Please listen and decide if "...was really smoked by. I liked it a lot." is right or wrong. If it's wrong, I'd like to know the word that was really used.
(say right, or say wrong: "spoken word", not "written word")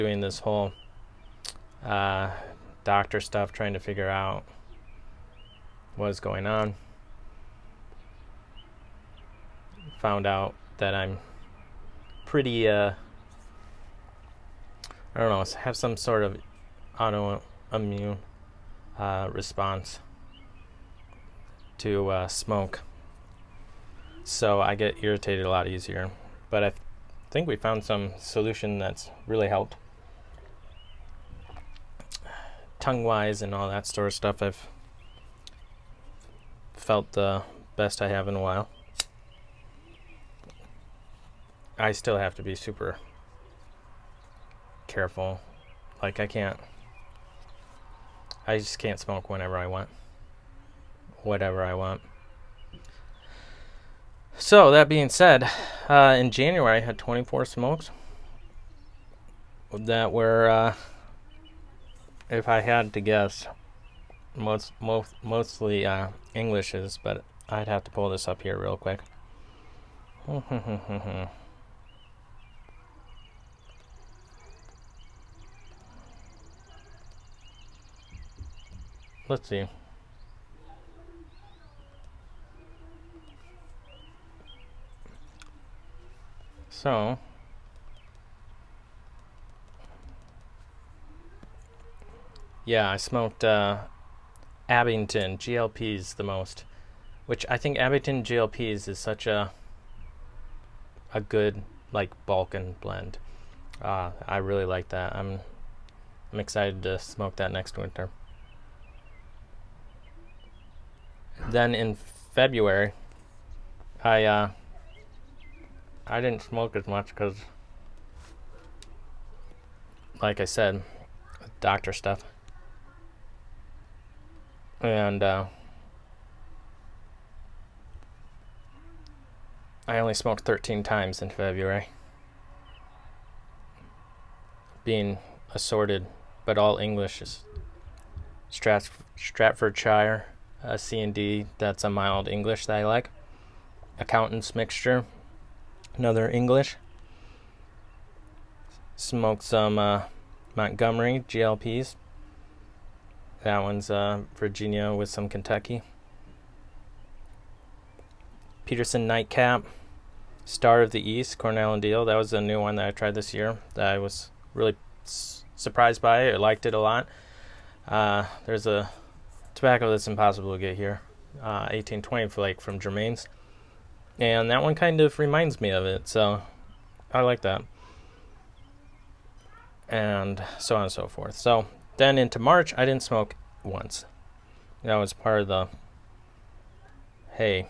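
wrong: "surprised", not "smoked".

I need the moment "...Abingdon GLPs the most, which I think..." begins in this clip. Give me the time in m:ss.
1:34.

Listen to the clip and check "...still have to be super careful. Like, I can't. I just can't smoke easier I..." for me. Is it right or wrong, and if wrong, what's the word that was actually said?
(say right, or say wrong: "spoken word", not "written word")
wrong: "whenever", not "easier".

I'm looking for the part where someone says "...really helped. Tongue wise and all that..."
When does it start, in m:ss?
0:29.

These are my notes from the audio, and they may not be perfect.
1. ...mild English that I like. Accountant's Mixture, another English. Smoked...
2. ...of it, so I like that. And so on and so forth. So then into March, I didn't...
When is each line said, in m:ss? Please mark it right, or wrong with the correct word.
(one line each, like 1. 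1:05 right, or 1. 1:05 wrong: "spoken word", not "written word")
1. 2:21 right
2. 2:55 right.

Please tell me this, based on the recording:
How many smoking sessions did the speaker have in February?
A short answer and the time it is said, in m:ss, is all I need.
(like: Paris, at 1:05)
13, at 2:10.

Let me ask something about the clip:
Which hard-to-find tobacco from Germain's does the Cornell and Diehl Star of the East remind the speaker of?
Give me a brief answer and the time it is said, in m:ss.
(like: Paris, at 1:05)
1820 flake, at 2:51.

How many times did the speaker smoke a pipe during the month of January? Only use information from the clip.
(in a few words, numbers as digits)
24.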